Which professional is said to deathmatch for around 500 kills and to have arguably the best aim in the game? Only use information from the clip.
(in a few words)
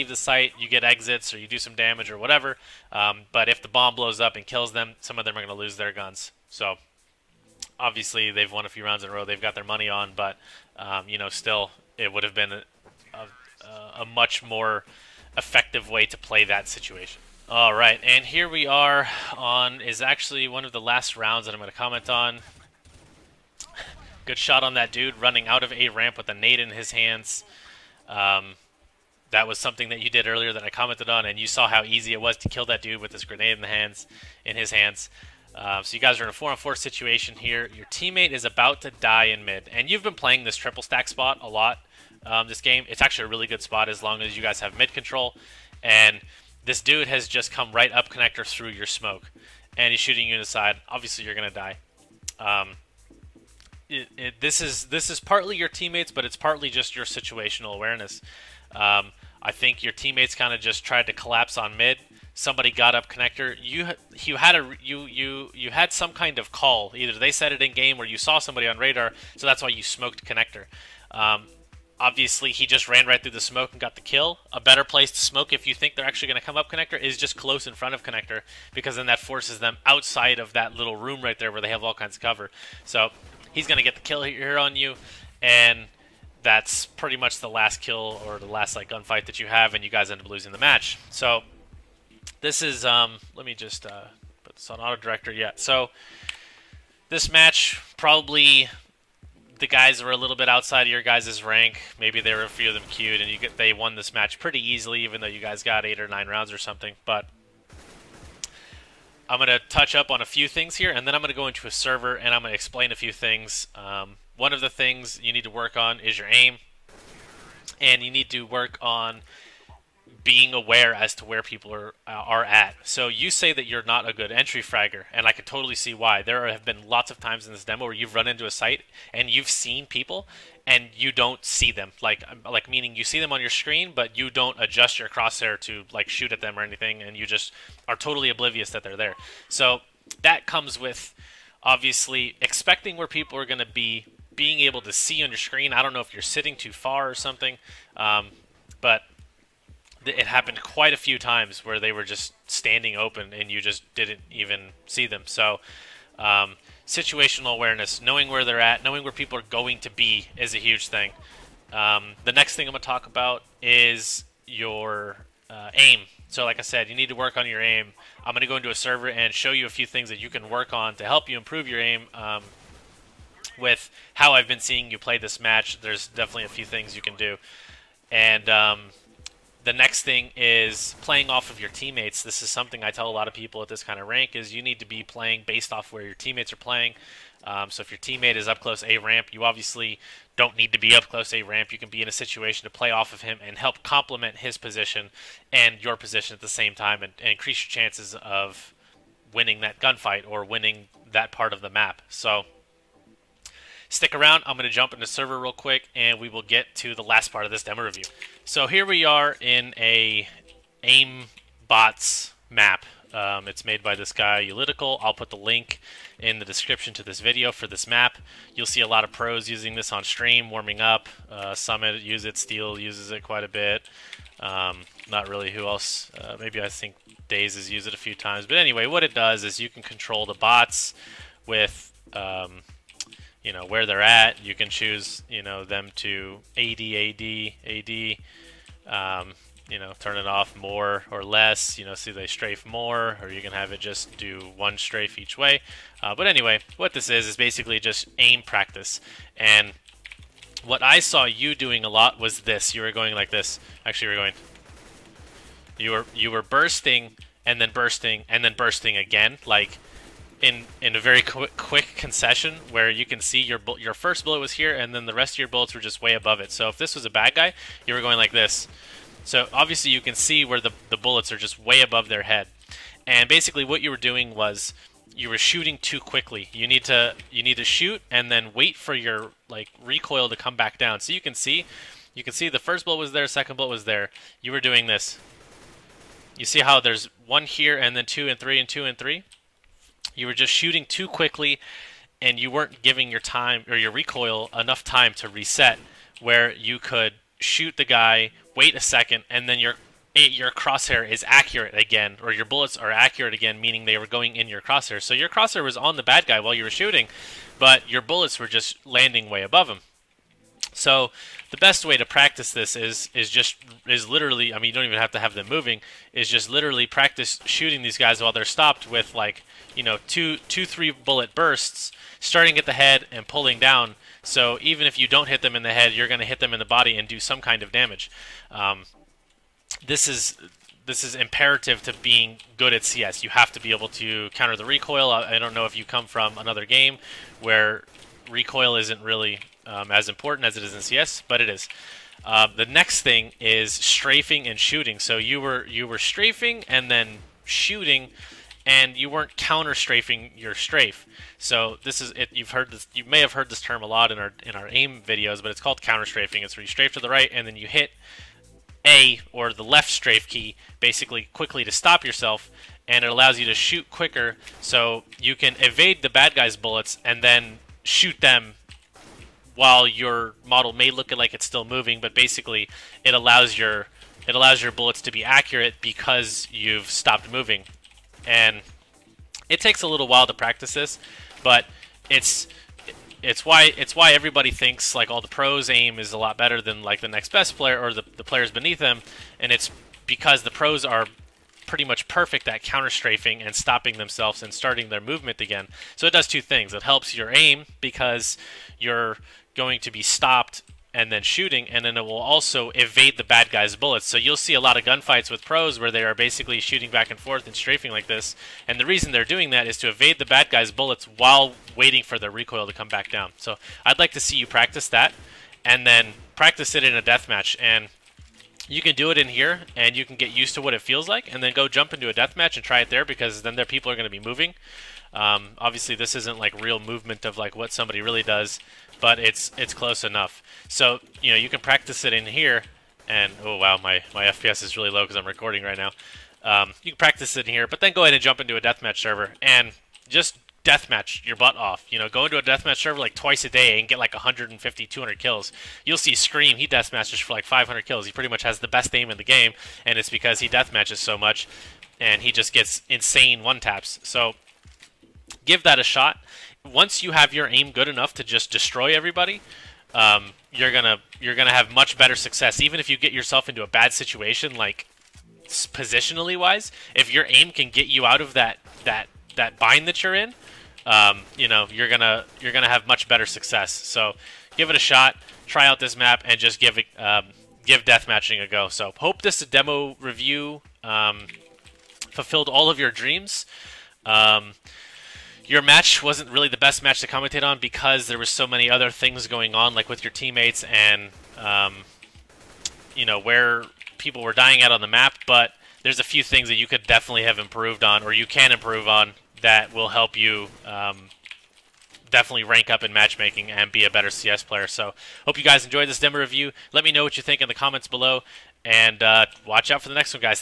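Scream.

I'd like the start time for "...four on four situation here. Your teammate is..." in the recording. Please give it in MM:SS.
00:36.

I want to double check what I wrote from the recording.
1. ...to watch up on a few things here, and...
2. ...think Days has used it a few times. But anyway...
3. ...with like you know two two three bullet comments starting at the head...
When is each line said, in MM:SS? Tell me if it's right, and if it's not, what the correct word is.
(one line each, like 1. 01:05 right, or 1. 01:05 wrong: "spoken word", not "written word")
1. 01:49 wrong: "touch", not "watch"
2. 03:46 right
3. 05:18 wrong: "bursts", not "comments".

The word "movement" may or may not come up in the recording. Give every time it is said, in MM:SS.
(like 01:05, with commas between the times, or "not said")
06:35, 07:06.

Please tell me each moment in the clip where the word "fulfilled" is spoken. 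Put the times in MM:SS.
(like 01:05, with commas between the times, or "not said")
08:02.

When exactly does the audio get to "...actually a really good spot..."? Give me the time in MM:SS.
00:43.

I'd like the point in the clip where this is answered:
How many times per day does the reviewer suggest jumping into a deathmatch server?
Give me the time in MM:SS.
07:23.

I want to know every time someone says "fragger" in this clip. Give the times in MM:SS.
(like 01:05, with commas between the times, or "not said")
02:04.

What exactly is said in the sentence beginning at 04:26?
So if this was a bad guy, you were going like this.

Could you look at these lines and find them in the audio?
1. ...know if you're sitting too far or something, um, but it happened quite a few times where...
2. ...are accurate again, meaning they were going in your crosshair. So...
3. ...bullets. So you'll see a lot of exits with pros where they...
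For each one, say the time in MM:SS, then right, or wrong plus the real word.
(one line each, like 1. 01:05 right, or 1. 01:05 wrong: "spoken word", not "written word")
1. 02:25 right
2. 05:02 right
3. 06:43 wrong: "gunfights", not "exits".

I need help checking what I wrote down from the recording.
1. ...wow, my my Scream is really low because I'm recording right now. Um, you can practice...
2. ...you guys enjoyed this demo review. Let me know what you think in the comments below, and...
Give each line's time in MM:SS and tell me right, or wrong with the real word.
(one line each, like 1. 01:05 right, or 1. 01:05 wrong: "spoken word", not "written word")
1. 07:13 wrong: "FPS", not "Scream"
2. 08:25 right.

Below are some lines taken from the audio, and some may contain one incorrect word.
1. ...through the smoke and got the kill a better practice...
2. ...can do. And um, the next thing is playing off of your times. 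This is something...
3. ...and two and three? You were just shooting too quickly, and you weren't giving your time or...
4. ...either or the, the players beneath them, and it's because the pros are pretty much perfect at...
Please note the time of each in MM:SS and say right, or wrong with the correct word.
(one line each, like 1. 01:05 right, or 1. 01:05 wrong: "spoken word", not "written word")
1. 01:13 wrong: "place", not "practice"
2. 02:57 wrong: "teammates", not "times"
3. 04:48 right
4. 06:27 wrong: "player", not "either".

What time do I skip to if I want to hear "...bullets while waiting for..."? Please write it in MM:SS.
06:50.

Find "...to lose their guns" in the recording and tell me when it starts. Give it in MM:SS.
00:05.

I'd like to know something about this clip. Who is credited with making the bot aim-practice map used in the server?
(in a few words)
uLLeticaL.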